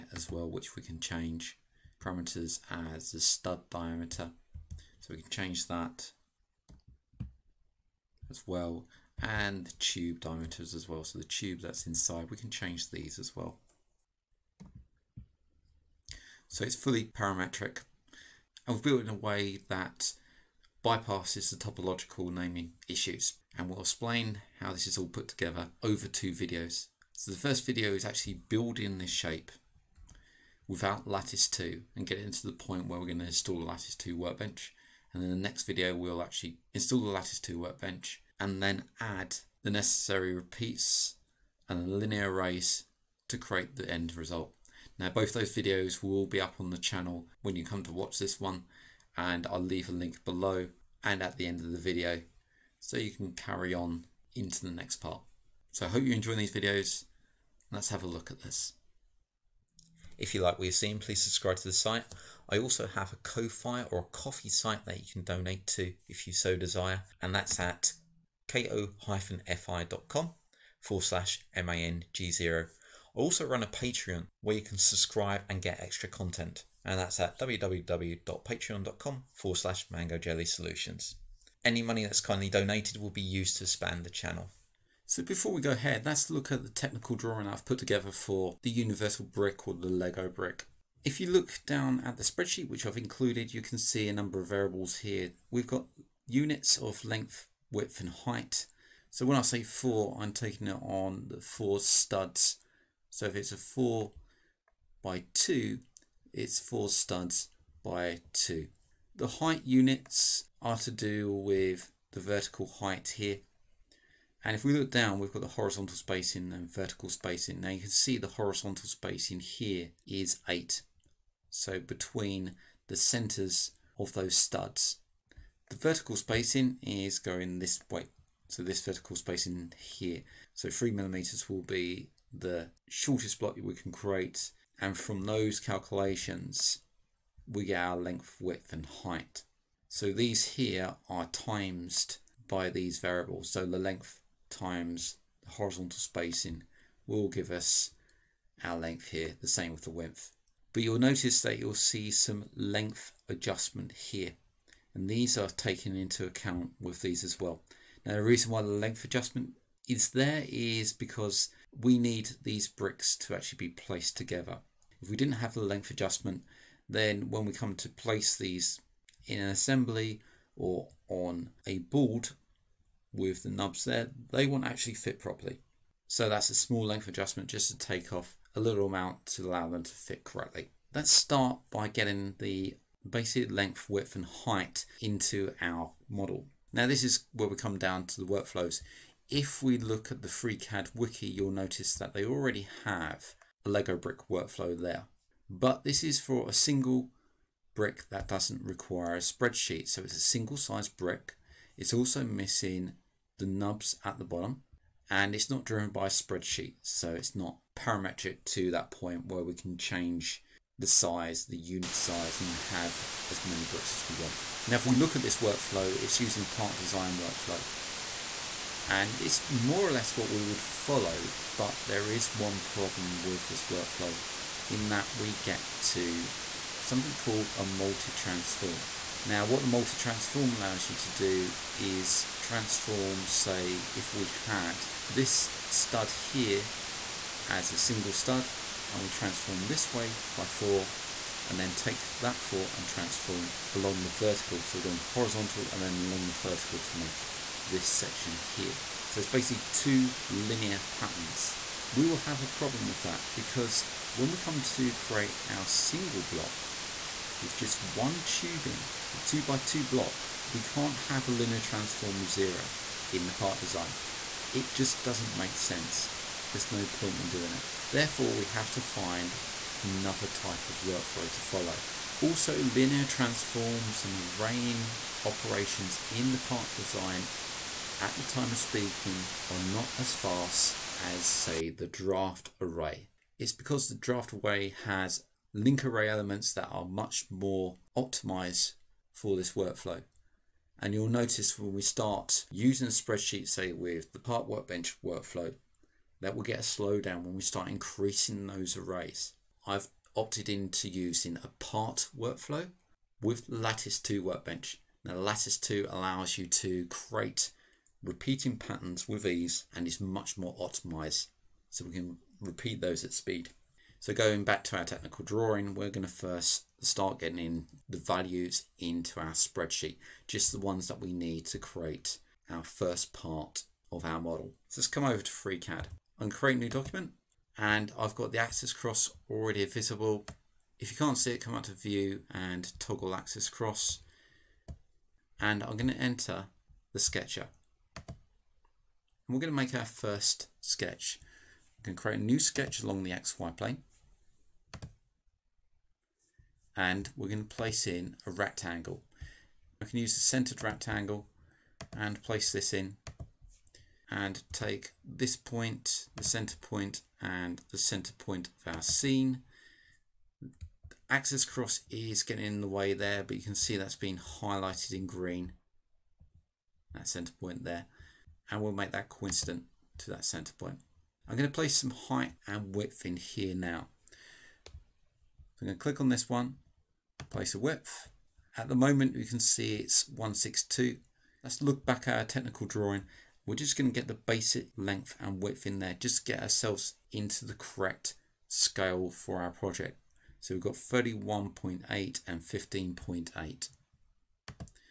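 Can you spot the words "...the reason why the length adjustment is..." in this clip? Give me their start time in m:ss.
2:38.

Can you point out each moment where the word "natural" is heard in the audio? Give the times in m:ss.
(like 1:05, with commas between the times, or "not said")
not said.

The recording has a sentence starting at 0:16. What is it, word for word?
So it's fully parametric and we've built in a way that bypasses the topological naming issues.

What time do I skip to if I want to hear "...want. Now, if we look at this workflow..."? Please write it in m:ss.
3:34.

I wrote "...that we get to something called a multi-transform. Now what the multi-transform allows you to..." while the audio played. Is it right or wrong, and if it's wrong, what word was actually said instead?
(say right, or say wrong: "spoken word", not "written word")
right.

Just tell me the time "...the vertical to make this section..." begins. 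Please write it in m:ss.
4:06.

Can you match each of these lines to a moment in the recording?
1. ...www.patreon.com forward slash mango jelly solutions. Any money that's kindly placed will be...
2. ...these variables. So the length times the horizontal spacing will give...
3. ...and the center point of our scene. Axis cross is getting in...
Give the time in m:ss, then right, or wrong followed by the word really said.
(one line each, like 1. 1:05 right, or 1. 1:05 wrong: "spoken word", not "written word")
1. 1:17 wrong: "donated", not "placed"
2. 2:22 right
3. 5:57 right.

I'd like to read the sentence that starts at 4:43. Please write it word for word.
It's because the draft array has link array elements that are much more optimized for this workflow.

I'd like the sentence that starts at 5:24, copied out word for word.
So let's come over to FreeCAD and create a new document.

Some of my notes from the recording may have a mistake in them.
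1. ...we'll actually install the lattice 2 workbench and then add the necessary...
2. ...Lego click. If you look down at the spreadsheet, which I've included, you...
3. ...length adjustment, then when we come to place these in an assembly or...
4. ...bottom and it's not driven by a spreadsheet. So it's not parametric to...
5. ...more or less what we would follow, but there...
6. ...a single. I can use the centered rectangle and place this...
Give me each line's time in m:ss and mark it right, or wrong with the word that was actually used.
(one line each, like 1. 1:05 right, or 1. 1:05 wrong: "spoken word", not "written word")
1. 0:35 right
2. 1:29 wrong: "brick", not "click"
3. 2:45 right
4. 3:24 right
5. 3:39 right
6. 5:48 wrong: "rectangle", not "single".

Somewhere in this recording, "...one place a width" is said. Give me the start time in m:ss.
6:16.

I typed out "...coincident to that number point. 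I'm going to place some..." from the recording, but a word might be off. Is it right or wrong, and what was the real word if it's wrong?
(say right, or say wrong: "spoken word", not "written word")
wrong: "center", not "number".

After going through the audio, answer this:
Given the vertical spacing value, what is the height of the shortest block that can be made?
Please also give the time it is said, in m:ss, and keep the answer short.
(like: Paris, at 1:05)
3 millimeters, at 2:10.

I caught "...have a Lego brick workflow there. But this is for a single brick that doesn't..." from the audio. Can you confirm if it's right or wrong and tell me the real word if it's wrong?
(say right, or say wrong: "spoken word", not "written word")
right.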